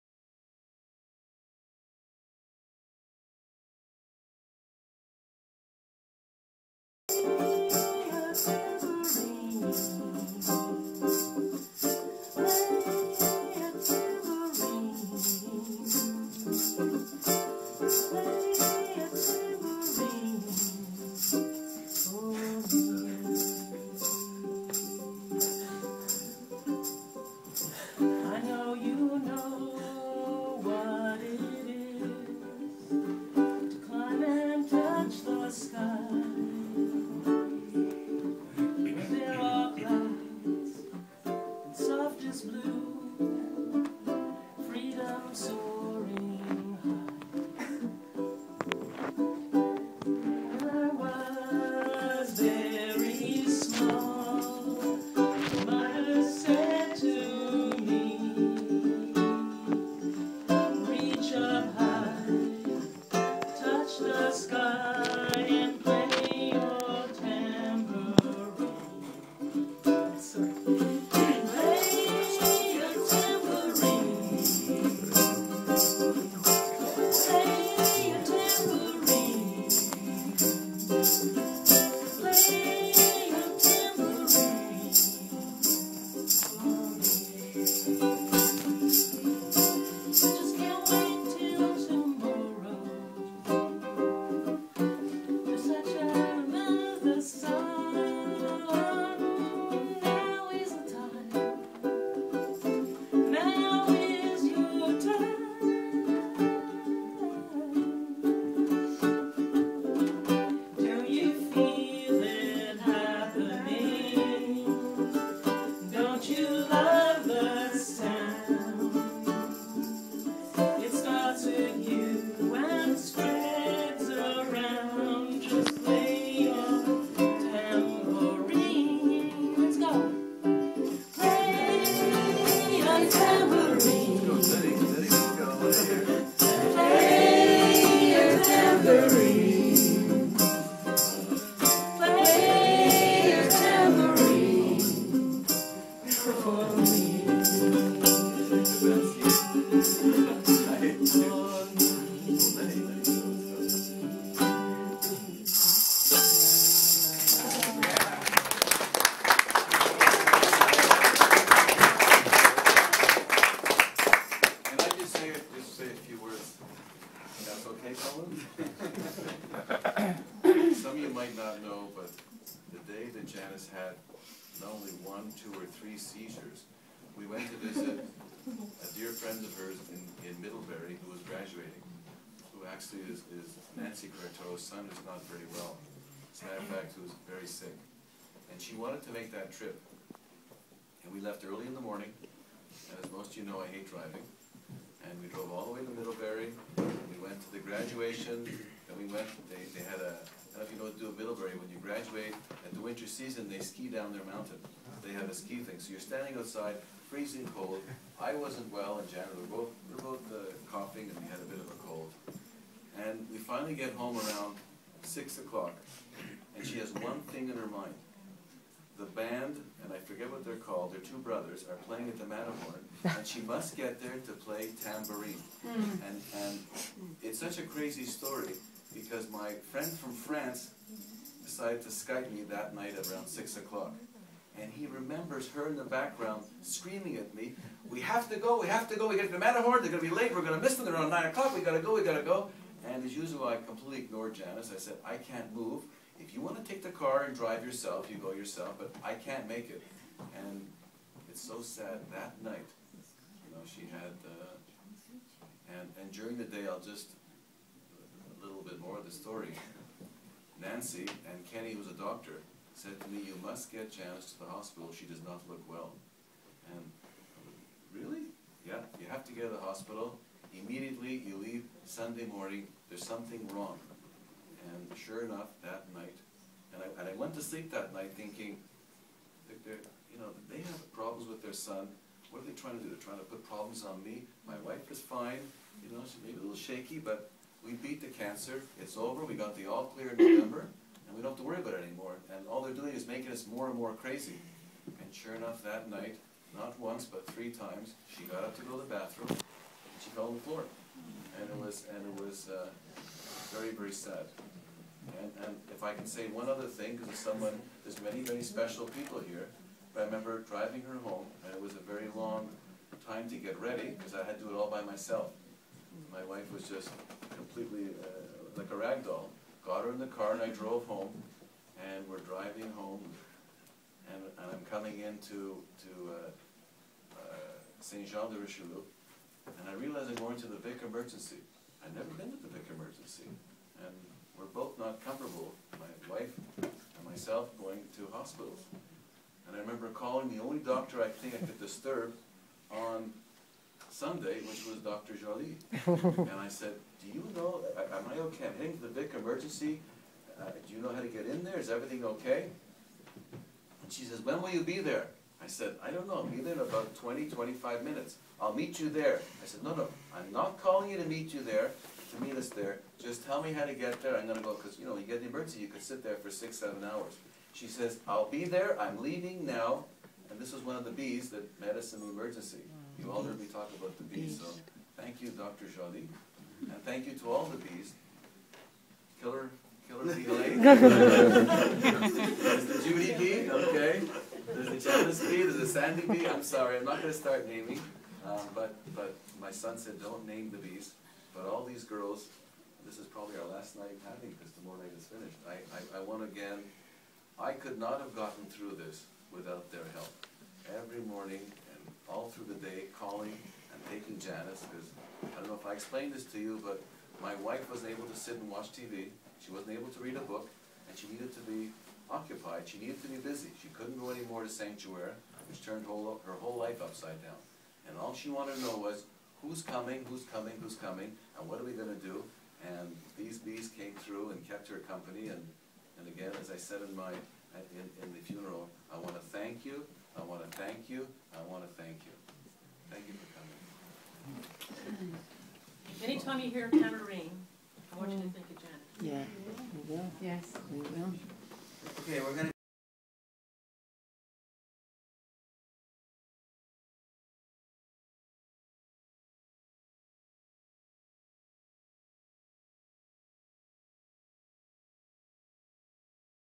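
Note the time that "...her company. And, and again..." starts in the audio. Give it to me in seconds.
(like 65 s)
424 s.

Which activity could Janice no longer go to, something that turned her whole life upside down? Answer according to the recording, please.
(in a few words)
Sanctuary.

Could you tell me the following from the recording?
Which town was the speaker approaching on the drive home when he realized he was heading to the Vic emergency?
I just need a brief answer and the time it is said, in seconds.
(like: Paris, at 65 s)
Saint Jean de Richelieu, at 327 s.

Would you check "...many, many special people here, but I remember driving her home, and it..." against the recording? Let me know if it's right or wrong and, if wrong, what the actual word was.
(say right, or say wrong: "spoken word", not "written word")
right.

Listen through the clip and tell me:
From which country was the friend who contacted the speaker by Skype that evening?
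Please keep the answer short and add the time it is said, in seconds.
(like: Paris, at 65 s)
France, at 230 s.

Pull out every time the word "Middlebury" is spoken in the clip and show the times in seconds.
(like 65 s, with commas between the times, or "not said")
180 s, 195 s, 201 s.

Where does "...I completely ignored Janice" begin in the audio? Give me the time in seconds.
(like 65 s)
243 s.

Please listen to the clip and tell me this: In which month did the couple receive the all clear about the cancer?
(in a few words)
November.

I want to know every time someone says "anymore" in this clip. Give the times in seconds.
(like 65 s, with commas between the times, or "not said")
291 s, 414 s.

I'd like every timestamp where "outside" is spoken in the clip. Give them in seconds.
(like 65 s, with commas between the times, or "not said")
206 s.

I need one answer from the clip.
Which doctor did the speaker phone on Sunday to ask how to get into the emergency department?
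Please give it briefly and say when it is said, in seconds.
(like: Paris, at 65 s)
Dr. Jolie, at 344 s.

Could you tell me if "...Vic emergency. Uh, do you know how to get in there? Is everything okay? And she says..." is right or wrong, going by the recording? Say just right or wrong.
right.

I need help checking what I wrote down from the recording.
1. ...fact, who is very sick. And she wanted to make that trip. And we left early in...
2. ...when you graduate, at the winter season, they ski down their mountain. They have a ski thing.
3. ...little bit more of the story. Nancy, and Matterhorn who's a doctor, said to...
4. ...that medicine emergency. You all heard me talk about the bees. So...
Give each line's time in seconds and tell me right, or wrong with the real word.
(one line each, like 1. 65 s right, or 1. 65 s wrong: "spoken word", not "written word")
1. 186 s right
2. 201 s right
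3. 258 s wrong: "Kenny", not "Matterhorn"
4. 371 s right.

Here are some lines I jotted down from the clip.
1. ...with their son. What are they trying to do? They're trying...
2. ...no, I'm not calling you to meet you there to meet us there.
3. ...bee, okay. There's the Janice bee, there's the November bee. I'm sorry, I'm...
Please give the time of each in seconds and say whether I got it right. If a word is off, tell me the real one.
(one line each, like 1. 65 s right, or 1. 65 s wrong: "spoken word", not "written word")
1. 281 s right
2. 359 s right
3. 383 s wrong: "Sandy", not "November".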